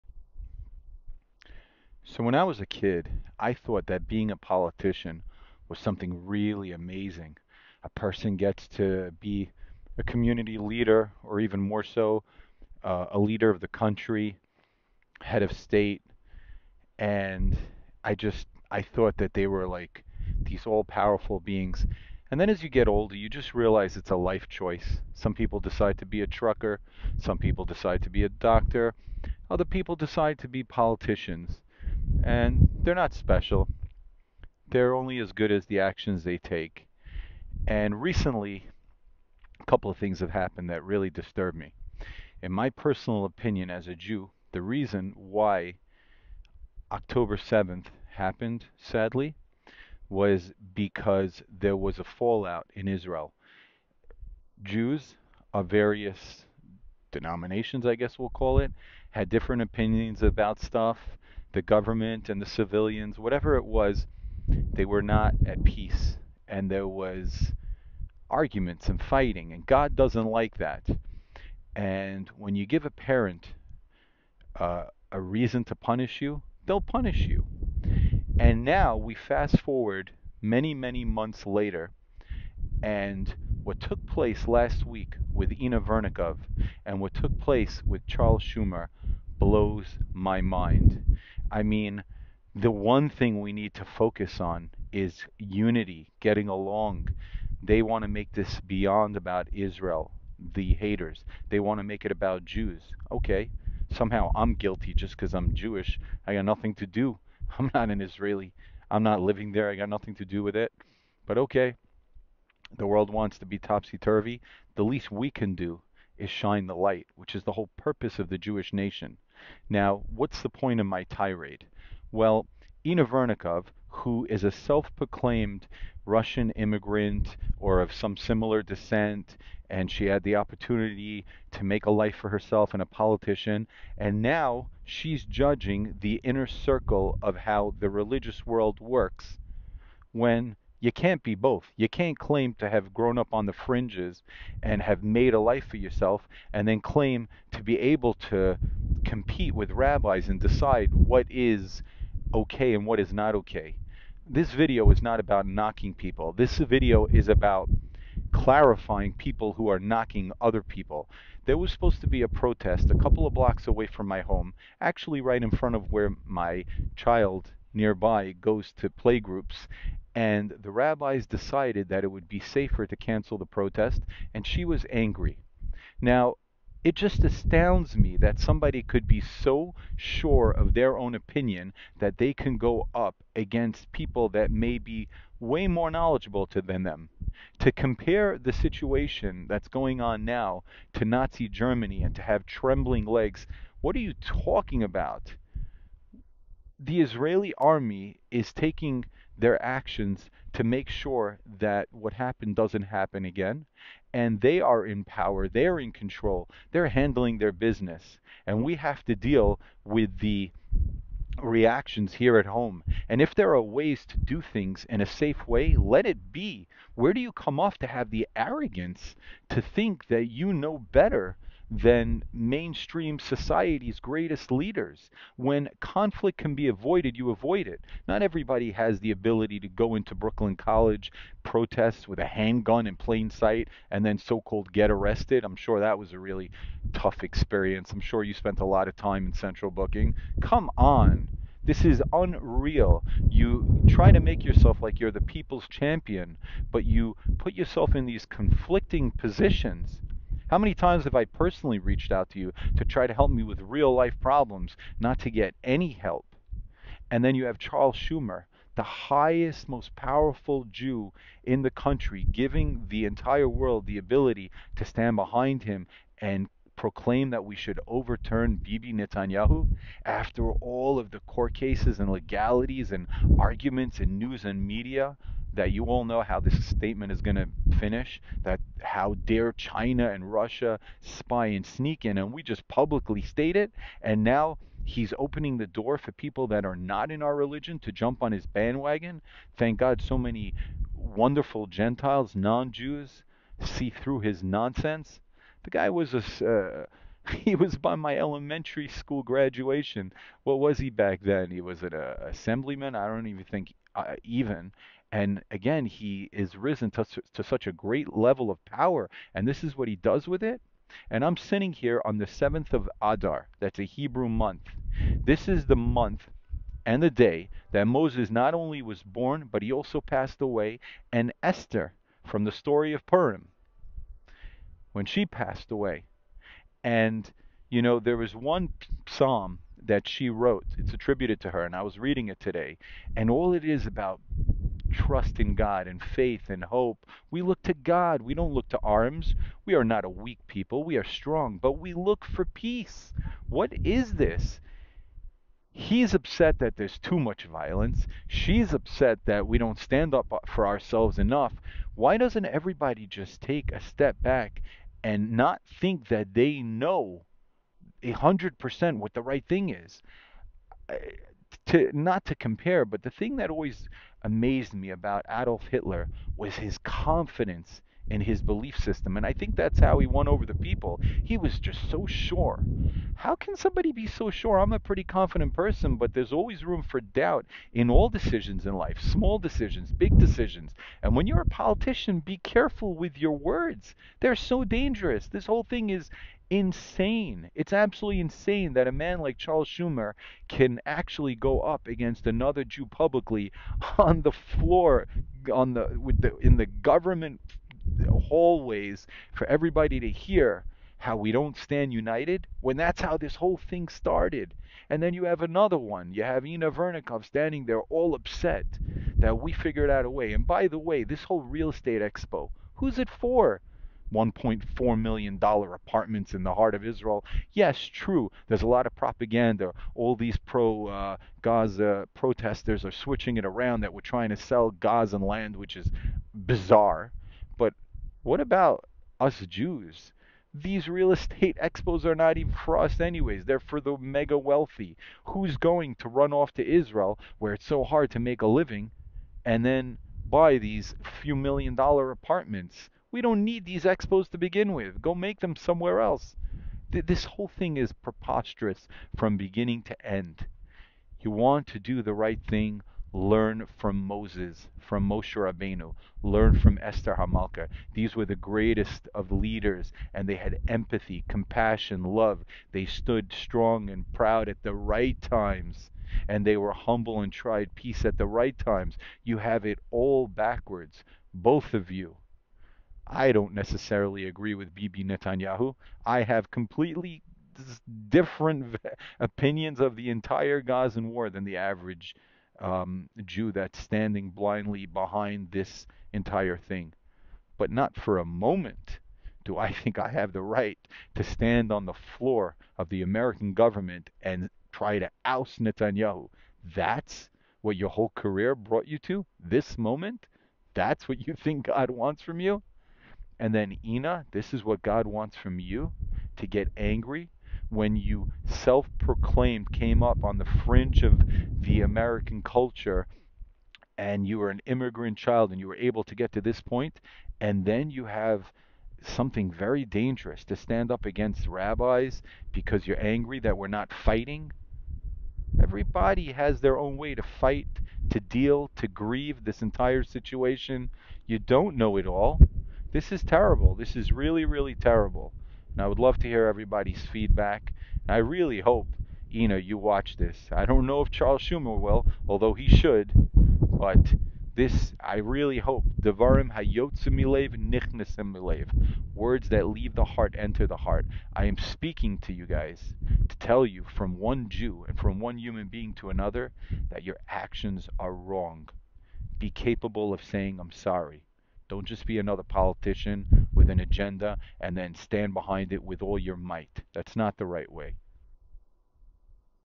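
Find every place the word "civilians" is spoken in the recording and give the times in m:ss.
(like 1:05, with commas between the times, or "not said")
1:02.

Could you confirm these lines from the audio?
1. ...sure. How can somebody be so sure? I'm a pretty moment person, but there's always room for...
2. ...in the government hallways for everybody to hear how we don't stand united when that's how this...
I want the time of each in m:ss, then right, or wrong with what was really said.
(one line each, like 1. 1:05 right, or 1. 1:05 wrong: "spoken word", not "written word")
1. 6:12 wrong: "confident", not "moment"
2. 6:36 right.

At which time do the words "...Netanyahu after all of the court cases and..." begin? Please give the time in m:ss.
4:28.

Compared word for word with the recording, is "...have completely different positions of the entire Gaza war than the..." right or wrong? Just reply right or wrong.
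wrong.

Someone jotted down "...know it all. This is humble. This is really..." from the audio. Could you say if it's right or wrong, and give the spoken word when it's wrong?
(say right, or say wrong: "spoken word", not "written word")
wrong: "terrible", not "humble".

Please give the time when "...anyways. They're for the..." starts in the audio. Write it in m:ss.
7:12.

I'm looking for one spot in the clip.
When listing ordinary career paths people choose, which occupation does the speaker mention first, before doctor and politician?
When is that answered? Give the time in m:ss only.
0:26.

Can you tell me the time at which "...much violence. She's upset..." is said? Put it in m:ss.
5:47.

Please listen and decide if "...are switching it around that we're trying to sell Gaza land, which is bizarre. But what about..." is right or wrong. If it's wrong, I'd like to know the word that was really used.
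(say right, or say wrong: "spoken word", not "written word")
right.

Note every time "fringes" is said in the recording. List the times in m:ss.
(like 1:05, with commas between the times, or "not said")
2:23, 8:30.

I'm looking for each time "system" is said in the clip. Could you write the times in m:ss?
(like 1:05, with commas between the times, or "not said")
6:08.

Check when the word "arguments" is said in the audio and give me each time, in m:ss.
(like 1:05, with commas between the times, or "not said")
1:08, 4:33.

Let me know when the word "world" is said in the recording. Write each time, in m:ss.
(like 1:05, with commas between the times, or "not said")
1:52, 2:18, 4:23.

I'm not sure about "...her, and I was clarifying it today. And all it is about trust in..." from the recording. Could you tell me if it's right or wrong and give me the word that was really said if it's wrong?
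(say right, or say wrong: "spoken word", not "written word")
wrong: "reading", not "clarifying".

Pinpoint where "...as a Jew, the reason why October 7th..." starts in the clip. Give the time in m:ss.
0:43.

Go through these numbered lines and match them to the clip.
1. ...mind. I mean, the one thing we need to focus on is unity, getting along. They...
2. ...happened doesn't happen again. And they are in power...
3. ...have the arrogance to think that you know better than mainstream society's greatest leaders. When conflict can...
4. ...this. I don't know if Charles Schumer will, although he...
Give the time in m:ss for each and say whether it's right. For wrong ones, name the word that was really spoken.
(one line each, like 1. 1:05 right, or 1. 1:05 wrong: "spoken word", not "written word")
1. 1:30 right
2. 3:22 right
3. 3:37 right
4. 9:00 right.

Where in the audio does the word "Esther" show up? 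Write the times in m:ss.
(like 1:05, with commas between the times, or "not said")
5:21, 7:36.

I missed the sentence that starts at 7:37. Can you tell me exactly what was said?
These were the greatest of leaders, and they had empathy, compassion, love.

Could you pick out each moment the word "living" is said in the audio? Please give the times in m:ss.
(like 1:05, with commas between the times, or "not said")
1:49, 7:18.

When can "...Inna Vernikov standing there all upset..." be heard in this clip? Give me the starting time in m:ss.
6:46.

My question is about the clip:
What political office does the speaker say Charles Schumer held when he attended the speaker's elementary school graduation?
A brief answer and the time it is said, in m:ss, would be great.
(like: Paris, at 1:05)
assemblyman, at 5:02.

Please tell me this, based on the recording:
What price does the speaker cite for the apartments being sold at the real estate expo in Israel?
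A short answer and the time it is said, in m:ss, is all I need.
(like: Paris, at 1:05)
$1.4 million, at 6:54.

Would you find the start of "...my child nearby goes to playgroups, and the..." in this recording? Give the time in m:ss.
2:46.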